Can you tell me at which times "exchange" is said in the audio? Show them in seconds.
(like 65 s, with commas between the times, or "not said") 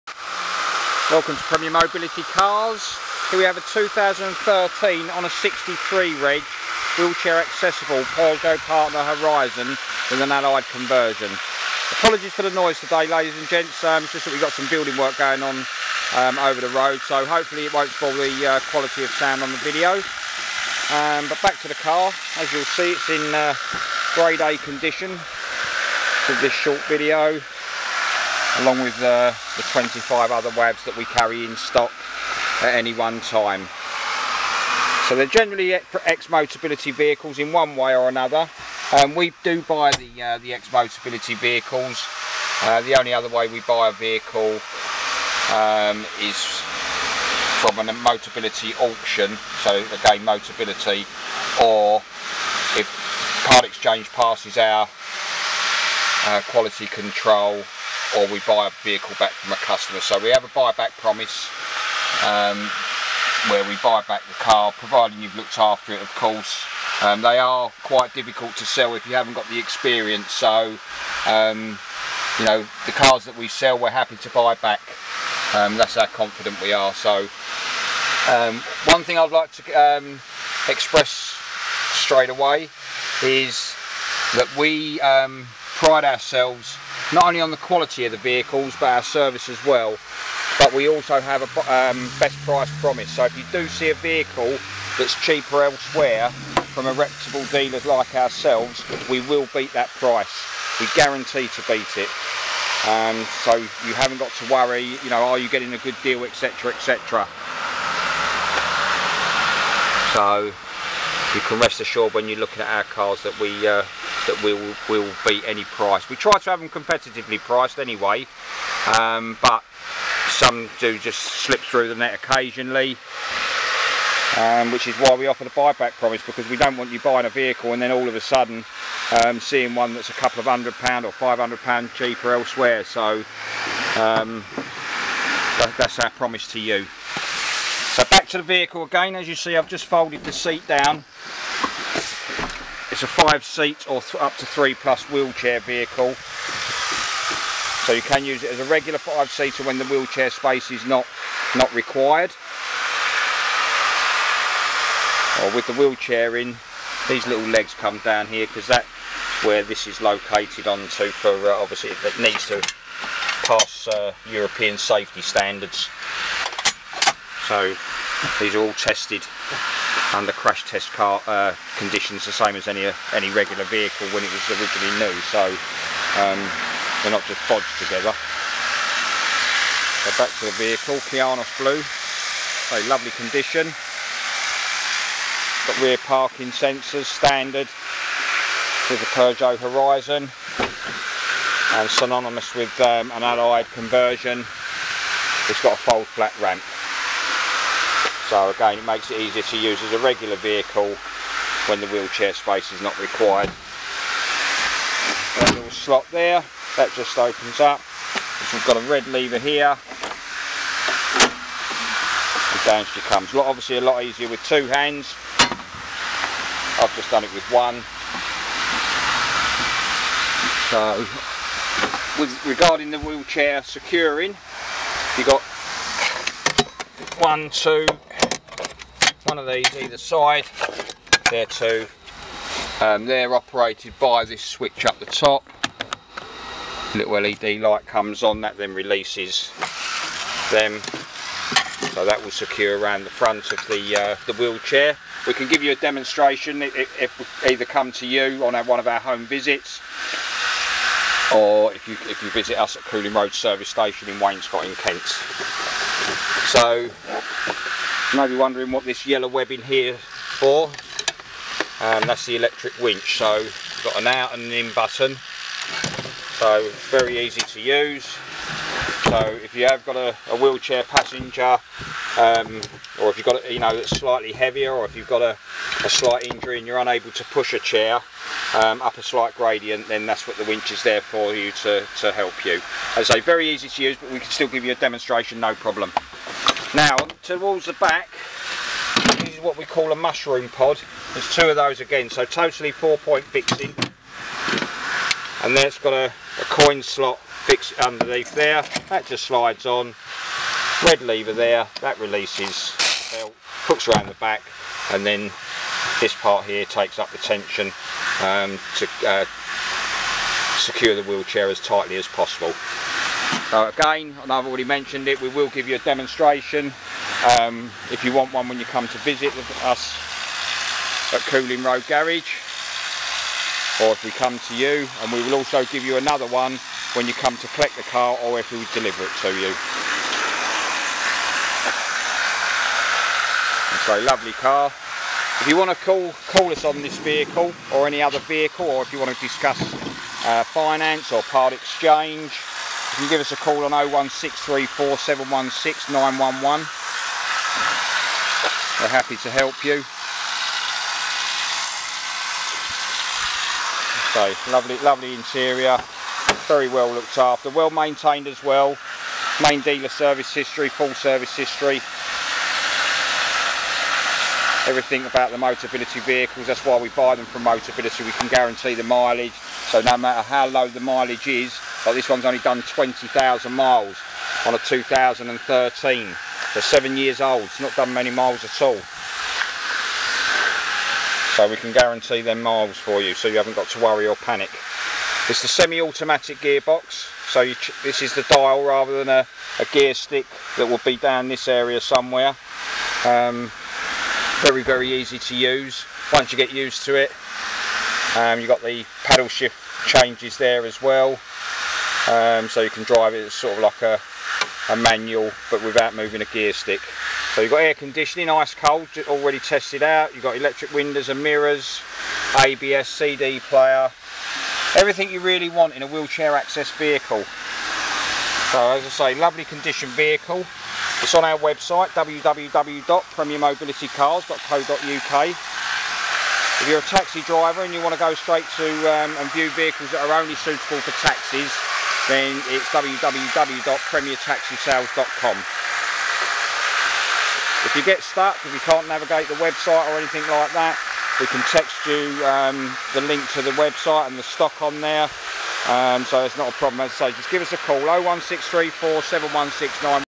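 53 s, 341 s.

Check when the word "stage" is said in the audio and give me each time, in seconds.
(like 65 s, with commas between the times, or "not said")
not said.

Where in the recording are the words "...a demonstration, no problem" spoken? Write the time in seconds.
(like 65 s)
284 s.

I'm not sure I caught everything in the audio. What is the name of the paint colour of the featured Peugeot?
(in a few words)
Kyanos Blue.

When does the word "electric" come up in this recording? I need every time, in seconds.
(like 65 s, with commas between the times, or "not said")
262 s, 410 s.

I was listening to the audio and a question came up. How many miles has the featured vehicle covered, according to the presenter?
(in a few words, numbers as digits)
20,000 miles.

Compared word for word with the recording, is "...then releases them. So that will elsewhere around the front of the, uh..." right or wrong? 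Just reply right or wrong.
wrong.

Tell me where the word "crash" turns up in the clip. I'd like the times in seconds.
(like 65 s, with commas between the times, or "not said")
170 s.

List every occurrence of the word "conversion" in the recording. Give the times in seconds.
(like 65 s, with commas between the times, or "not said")
10 s, 193 s.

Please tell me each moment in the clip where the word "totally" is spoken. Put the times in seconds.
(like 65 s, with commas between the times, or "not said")
292 s.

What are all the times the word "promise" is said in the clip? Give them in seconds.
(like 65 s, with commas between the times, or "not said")
60 s, 92 s, 125 s, 136 s.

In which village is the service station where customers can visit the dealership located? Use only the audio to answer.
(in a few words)
Wainscott.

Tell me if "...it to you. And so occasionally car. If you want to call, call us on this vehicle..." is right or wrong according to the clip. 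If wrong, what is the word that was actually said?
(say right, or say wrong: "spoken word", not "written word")
wrong: "lovely", not "occasionally".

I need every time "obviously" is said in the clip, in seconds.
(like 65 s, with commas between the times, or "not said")
161 s, 213 s.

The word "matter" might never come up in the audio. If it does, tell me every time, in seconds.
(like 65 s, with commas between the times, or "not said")
369 s.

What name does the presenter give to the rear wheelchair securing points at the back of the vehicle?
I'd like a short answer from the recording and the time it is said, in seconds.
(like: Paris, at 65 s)
Mushroom pod, at 289 s.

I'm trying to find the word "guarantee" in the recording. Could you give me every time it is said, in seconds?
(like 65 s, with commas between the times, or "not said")
100 s, 368 s, 381 s.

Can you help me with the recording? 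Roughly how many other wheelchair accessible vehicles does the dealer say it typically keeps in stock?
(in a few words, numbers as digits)
25.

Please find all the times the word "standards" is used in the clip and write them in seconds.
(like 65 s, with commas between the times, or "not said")
165 s, 187 s.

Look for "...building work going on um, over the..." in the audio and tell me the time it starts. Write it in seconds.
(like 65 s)
14 s.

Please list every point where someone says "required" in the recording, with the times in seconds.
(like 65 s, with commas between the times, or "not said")
151 s, 202 s.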